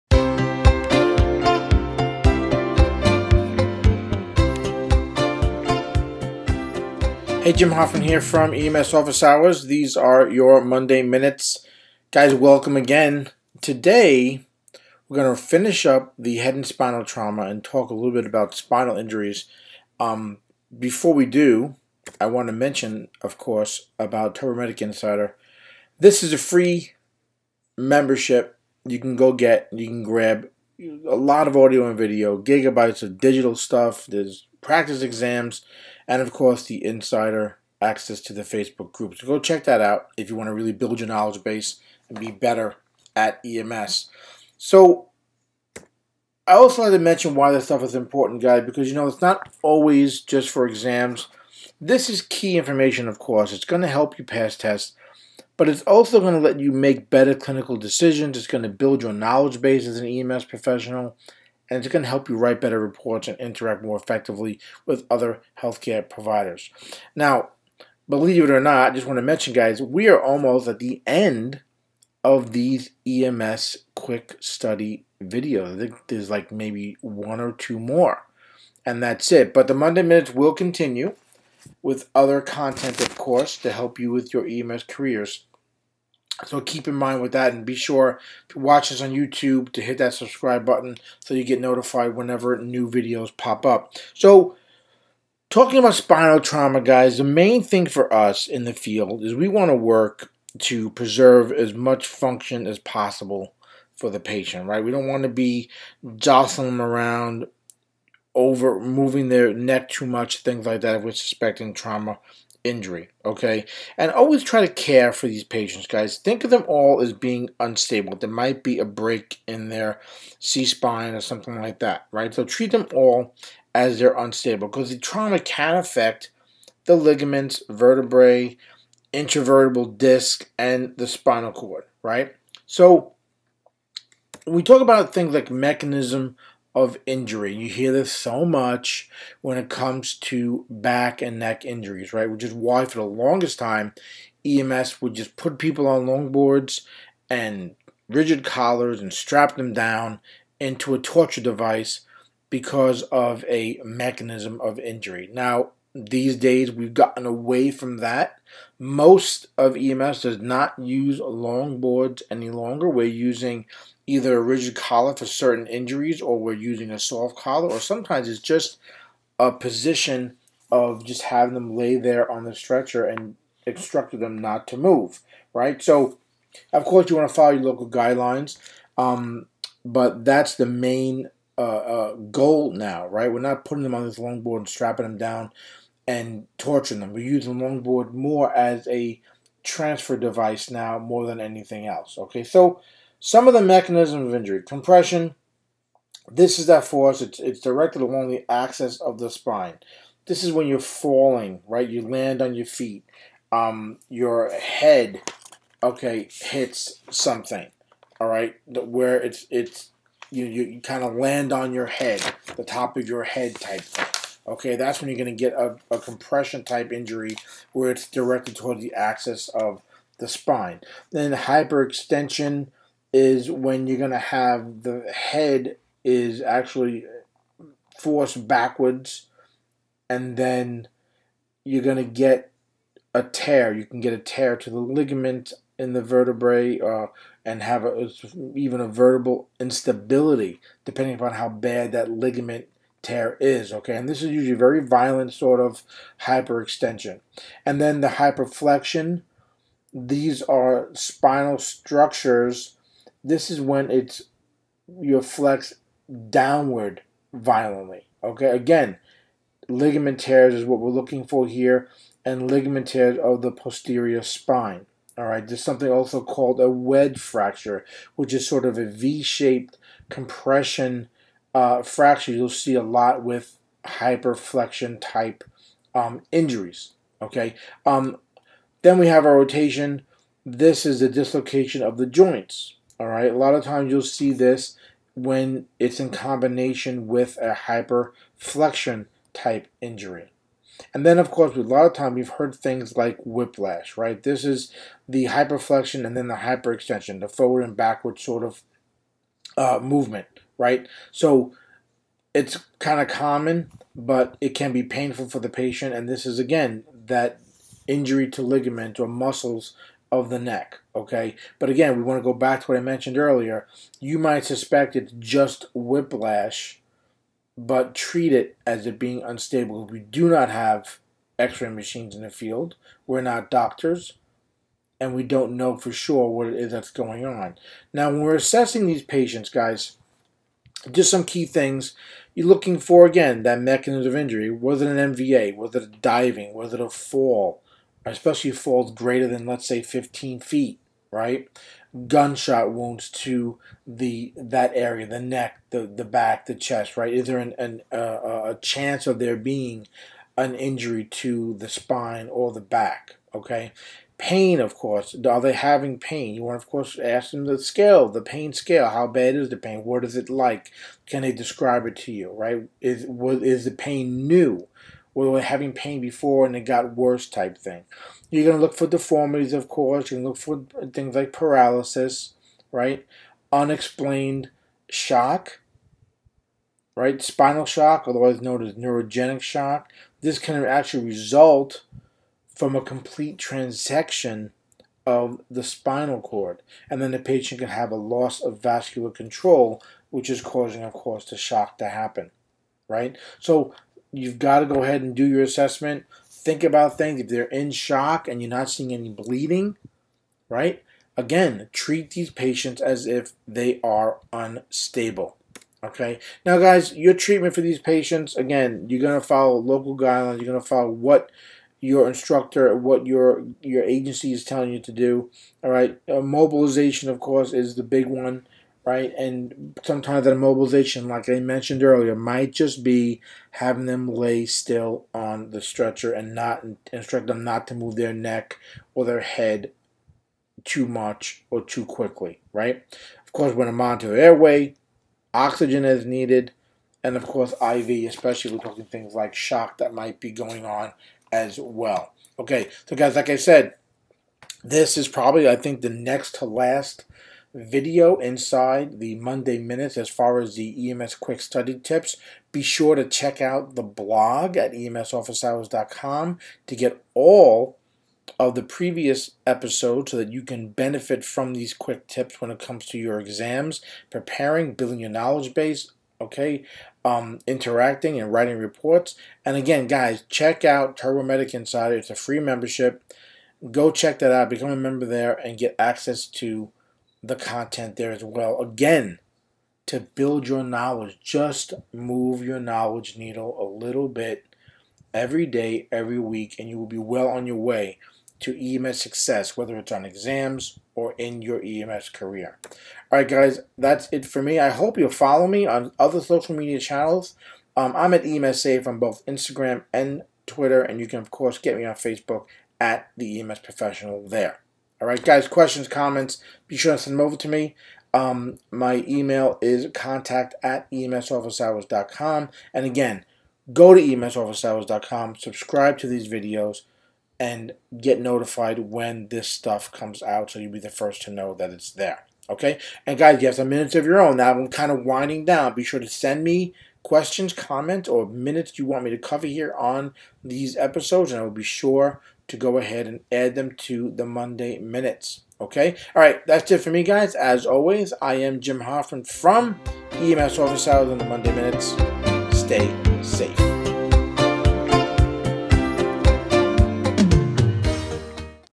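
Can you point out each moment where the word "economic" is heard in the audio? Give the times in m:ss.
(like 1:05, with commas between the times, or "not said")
not said.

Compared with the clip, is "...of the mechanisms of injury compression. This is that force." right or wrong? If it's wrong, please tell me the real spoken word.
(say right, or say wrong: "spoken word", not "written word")
right.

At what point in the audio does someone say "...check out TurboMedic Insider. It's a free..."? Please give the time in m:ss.
7:50.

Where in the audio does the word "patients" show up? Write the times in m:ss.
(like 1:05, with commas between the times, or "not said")
1:44, 1:55, 5:05, 5:29, 6:27, 6:42, 6:47.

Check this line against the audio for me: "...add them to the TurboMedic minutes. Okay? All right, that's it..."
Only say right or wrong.
wrong.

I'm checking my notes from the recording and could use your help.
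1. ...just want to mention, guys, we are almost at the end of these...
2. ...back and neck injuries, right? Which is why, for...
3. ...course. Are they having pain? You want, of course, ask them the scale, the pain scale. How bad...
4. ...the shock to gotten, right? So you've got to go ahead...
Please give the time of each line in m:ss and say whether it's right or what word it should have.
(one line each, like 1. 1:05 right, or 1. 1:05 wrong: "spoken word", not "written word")
1. 1:08 right
2. 2:20 right
3. 5:54 right
4. 6:31 wrong: "happen", not "gotten".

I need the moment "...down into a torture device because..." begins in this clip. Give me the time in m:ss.
2:29.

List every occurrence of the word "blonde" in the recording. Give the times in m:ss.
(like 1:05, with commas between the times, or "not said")
not said.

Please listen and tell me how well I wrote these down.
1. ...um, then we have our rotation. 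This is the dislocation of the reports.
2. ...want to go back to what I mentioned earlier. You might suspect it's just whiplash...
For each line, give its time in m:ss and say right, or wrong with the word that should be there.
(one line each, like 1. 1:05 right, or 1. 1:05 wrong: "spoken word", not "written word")
1. 4:37 wrong: "joints", not "reports"
2. 5:12 right.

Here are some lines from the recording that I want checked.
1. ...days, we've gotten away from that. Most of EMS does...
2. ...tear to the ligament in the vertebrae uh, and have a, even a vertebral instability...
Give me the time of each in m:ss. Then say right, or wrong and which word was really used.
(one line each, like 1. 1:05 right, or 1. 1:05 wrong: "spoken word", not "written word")
1. 2:36 right
2. 3:54 right.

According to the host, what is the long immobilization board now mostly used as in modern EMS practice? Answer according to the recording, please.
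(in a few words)
transfer device.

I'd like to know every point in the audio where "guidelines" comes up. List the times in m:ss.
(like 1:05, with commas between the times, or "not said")
2:57, 6:49.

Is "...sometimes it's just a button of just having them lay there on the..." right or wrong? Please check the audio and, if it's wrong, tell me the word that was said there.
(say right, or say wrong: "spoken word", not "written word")
wrong: "position", not "button".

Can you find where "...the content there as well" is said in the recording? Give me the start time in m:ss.
7:57.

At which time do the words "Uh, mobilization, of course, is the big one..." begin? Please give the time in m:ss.
6:56.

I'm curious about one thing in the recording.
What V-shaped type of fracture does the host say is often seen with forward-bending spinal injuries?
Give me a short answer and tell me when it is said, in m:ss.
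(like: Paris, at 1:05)
wedge fracture, at 4:26.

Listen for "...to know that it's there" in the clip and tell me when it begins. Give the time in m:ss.
8:41.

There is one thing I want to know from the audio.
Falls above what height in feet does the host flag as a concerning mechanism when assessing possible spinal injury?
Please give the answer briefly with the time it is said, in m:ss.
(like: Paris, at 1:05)
15, at 5:39.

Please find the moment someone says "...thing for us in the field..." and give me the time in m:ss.
1:37.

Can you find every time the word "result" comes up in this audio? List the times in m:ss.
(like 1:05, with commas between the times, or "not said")
6:21.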